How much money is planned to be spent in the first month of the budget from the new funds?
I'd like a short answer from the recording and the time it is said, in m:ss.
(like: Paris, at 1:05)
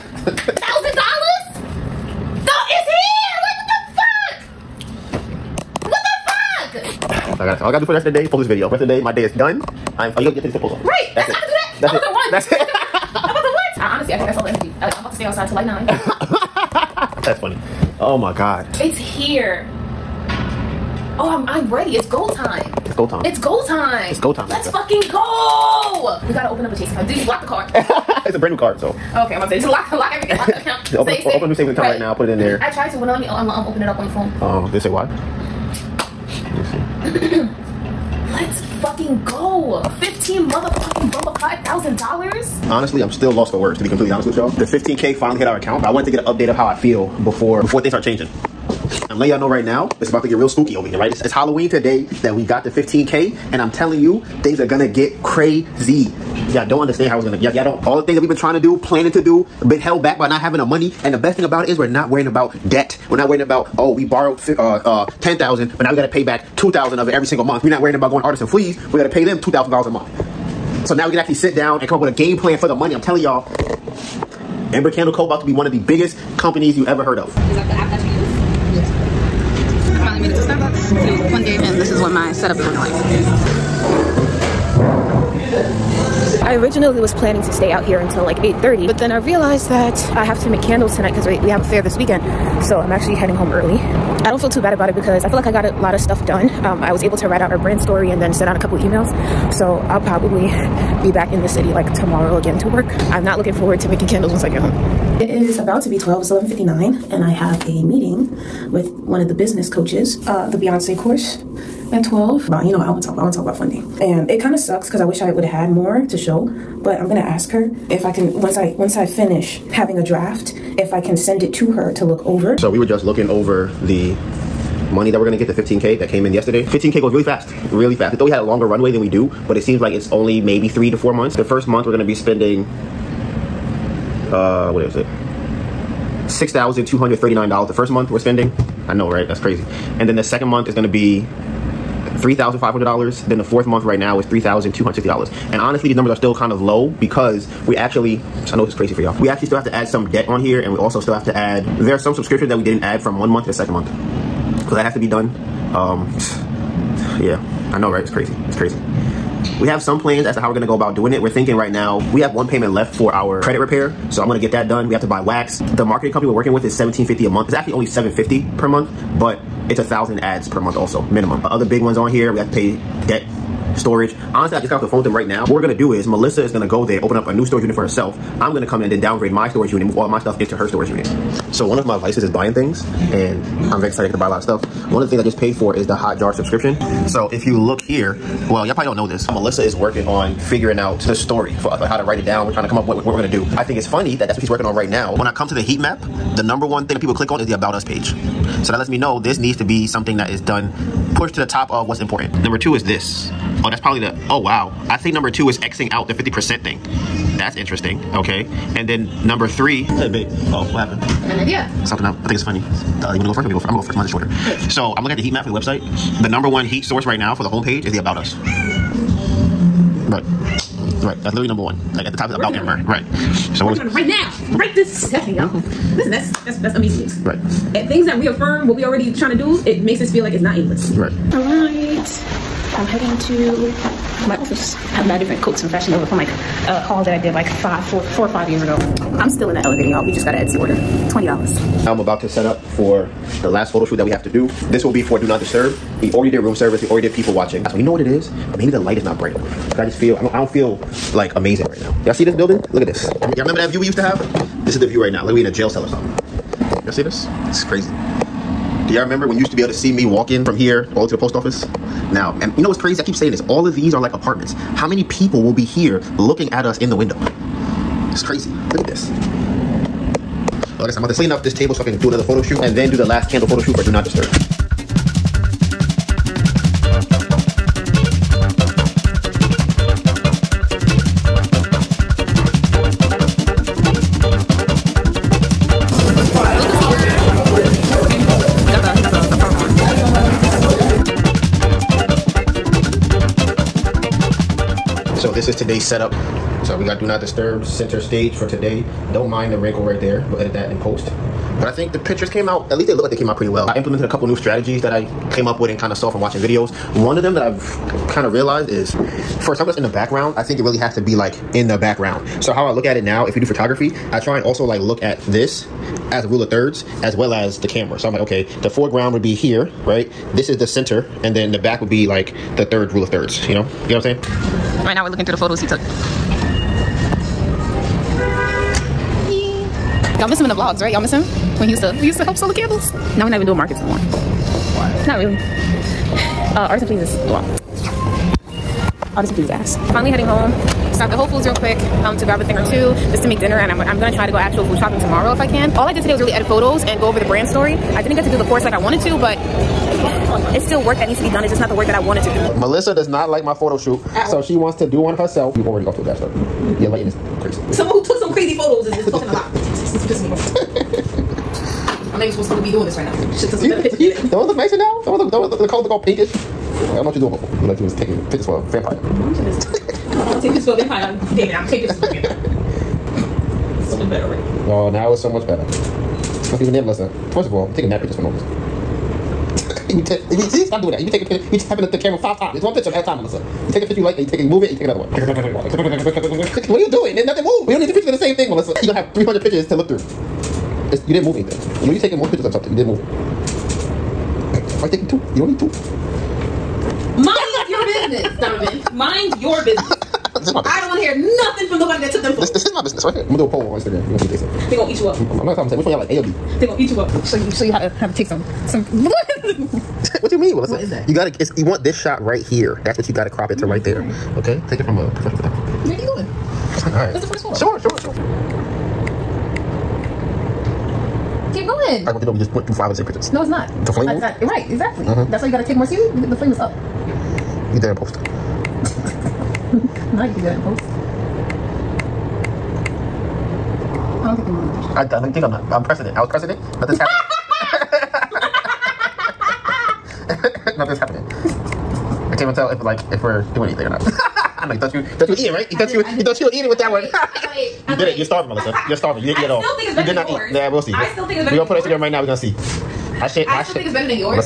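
$6,239, at 2:16.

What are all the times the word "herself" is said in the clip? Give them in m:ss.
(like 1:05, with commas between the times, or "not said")
2:57, 5:55.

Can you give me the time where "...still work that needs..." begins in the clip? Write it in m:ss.
5:50.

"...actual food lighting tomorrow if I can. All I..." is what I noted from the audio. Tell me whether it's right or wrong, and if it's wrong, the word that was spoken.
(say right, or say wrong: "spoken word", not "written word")
wrong: "shopping", not "lighting".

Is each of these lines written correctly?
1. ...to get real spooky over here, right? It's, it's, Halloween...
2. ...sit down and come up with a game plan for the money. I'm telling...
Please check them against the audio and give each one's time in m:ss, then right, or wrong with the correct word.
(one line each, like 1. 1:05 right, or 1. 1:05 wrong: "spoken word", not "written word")
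1. 0:50 right
2. 1:11 right.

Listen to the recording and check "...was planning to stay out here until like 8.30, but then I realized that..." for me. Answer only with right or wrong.
right.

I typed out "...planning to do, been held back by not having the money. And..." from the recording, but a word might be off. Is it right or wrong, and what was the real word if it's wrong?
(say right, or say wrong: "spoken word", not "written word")
right.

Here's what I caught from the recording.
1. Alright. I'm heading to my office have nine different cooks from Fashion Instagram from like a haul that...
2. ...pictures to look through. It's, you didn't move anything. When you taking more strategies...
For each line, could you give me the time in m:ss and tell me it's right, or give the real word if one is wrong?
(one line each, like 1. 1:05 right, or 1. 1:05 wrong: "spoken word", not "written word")
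1. 3:51 wrong: "Nova", not "Instagram"
2. 6:29 wrong: "pictures", not "strategies".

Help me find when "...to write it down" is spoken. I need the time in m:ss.
3:11.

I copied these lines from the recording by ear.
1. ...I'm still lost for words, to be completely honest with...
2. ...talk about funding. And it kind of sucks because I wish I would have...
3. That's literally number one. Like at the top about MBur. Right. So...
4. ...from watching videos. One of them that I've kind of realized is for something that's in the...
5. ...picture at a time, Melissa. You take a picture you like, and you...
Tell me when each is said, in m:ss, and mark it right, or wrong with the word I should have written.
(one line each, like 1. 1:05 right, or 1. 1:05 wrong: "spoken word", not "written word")
1. 0:43 right
2. 1:53 right
3. 3:41 right
4. 5:06 right
5. 6:22 right.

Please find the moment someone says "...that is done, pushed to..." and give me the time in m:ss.
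3:20.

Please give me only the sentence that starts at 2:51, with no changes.
Uh, other big ones on here, we have to pay debt storage.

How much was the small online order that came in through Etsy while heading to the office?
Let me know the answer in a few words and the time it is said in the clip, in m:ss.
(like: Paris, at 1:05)
$20, at 4:00.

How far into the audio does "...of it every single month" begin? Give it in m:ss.
1:06.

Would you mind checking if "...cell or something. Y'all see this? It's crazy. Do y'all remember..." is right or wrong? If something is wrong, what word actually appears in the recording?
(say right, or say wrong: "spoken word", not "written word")
right.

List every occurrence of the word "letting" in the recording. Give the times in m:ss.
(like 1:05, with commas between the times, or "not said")
0:49.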